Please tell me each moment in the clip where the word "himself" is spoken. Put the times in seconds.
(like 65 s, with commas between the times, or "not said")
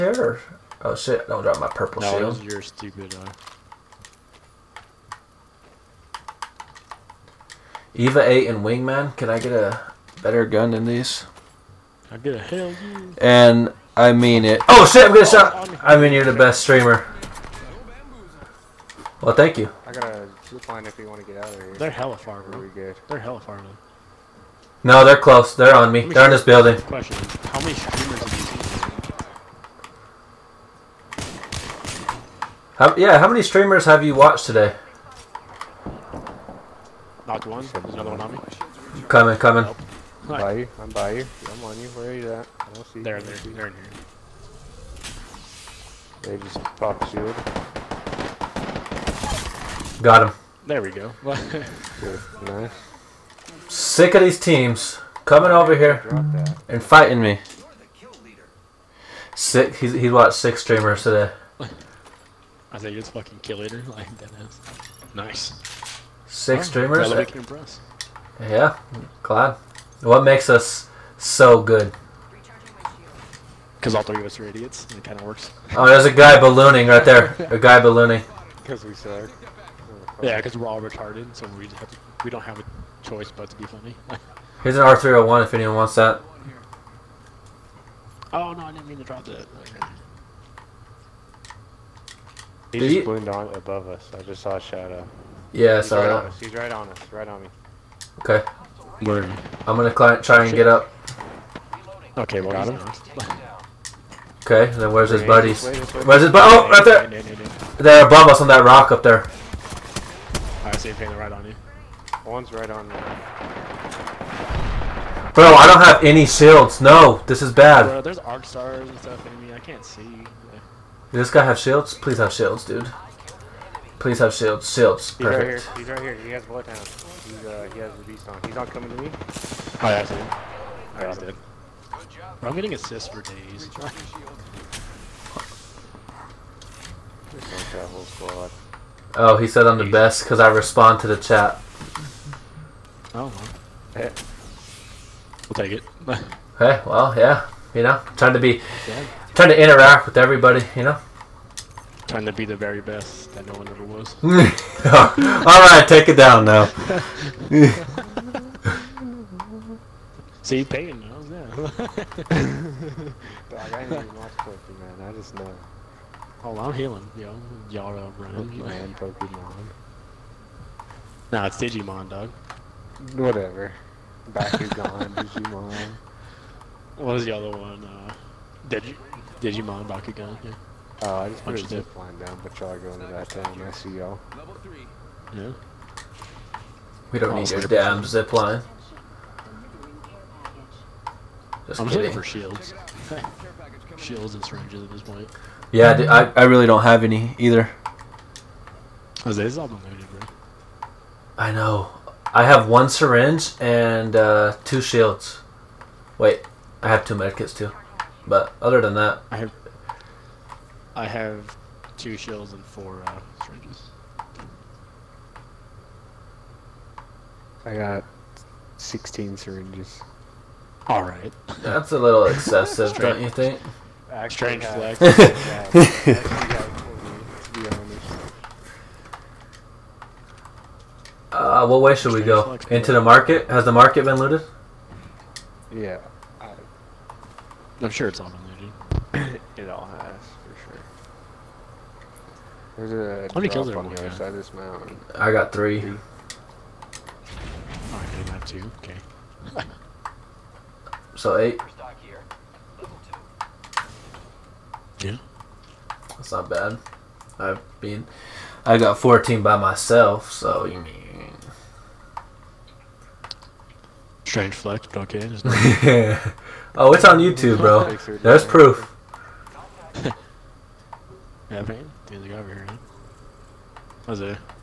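not said.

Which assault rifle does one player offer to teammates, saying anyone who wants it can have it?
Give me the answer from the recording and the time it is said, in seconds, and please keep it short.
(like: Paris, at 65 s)
R301, at 84 s.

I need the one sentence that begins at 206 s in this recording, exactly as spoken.
Wait, I have two medkits too.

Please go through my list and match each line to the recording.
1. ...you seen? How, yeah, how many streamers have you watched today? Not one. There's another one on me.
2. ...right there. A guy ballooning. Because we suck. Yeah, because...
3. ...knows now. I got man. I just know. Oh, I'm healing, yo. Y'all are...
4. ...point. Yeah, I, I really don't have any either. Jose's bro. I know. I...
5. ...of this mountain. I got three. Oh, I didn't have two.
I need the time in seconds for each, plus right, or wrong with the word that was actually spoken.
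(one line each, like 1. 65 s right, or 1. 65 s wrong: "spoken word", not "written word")
1. 28 s right
2. 76 s right
3. 161 s right
4. 195 s right
5. 244 s right.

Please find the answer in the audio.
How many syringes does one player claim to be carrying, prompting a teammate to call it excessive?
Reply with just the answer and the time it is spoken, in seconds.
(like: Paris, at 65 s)
16, at 218 s.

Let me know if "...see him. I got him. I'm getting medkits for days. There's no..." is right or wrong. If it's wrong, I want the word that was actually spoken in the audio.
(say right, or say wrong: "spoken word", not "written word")
wrong: "assists", not "medkits".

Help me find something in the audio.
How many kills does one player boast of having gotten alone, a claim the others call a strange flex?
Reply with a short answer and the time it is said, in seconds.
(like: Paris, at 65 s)
14, at 258 s.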